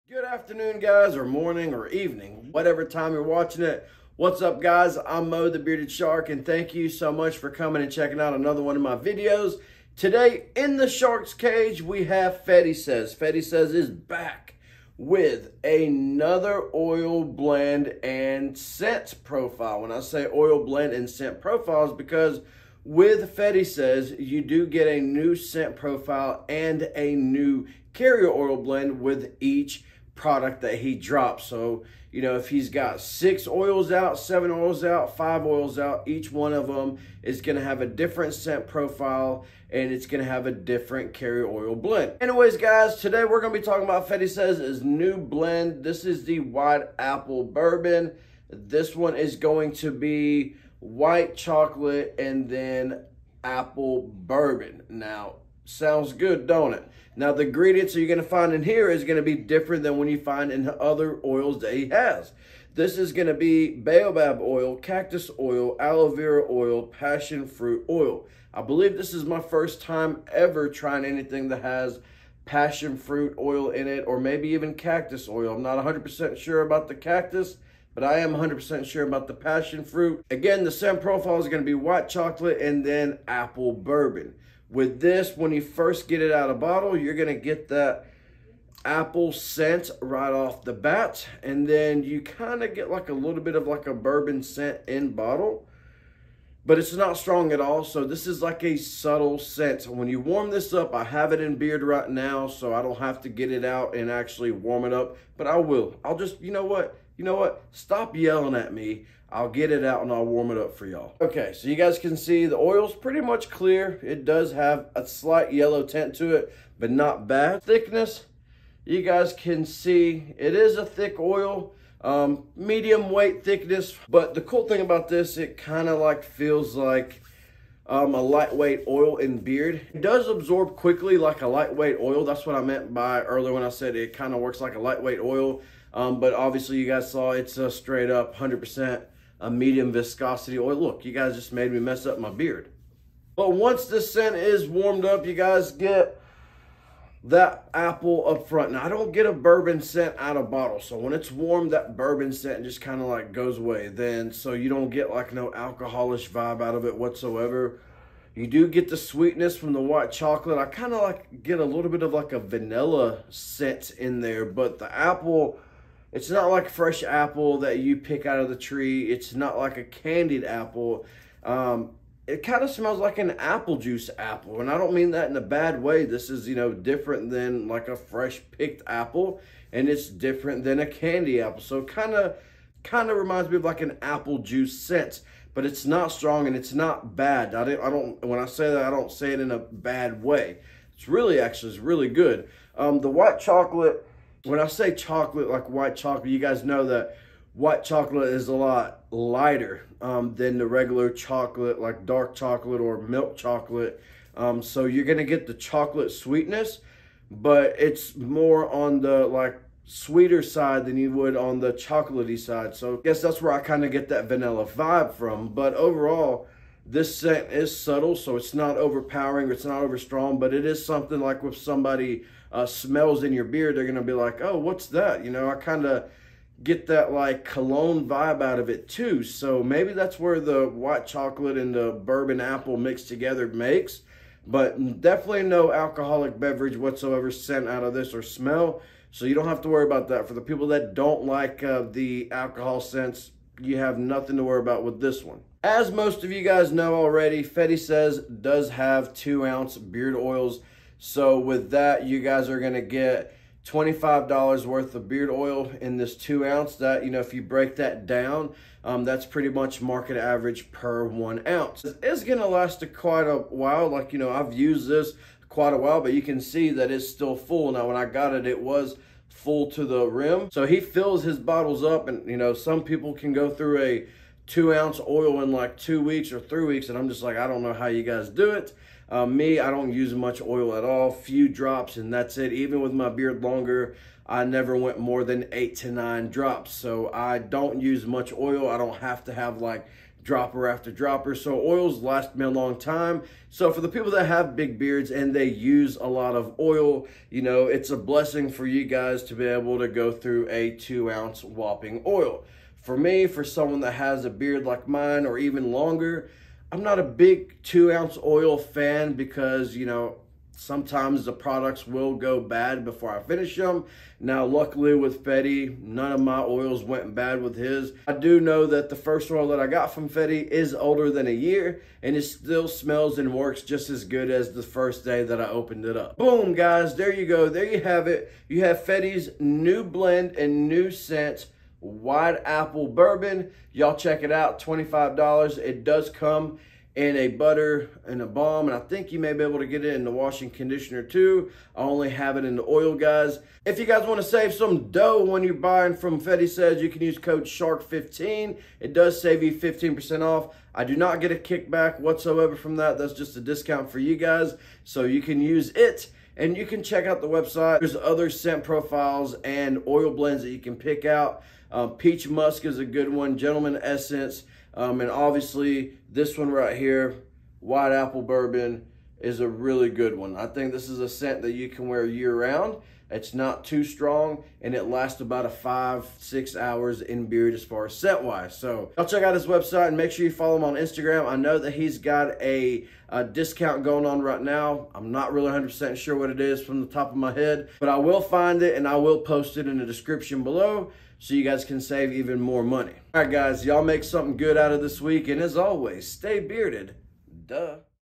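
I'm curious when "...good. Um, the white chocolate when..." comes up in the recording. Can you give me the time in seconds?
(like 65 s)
192 s.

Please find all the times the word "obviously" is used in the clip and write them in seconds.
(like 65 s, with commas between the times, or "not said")
136 s, 365 s.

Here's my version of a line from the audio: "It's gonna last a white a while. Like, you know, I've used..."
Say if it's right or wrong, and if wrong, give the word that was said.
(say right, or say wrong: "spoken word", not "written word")
wrong: "quite", not "white".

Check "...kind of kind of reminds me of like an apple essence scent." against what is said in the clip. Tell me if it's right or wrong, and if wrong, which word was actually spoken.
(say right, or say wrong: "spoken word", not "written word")
wrong: "juice", not "essence".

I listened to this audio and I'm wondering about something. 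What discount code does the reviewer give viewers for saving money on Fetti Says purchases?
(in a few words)
SHARK15.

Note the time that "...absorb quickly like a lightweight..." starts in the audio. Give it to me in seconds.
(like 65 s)
130 s.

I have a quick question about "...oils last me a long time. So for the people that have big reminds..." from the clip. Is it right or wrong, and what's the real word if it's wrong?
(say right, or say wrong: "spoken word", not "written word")
wrong: "beards", not "reminds".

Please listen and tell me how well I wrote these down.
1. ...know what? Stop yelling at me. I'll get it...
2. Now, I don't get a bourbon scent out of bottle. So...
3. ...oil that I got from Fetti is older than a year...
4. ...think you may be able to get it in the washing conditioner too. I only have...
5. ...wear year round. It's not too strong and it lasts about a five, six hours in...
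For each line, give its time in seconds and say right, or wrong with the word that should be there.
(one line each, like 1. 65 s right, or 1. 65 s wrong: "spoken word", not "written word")
1. 107 s right
2. 148 s right
3. 319 s right
4. 338 s right
5. 371 s right.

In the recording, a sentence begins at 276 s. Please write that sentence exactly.
And I'm just like, I don't know how you guys do it.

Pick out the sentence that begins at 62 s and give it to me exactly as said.
This is going to be baobab oil, cactus oil, aloe vera oil, passion fruit oil.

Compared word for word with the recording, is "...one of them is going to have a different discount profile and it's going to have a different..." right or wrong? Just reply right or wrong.
wrong.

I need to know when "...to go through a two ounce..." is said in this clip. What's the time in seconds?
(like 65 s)
299 s.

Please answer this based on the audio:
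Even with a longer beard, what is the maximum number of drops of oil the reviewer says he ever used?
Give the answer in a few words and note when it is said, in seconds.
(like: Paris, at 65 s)
8 to 9 drops, at 285 s.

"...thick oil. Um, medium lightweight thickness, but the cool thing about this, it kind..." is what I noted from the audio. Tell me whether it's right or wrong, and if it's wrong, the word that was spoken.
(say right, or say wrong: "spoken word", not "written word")
wrong: "weight", not "lightweight".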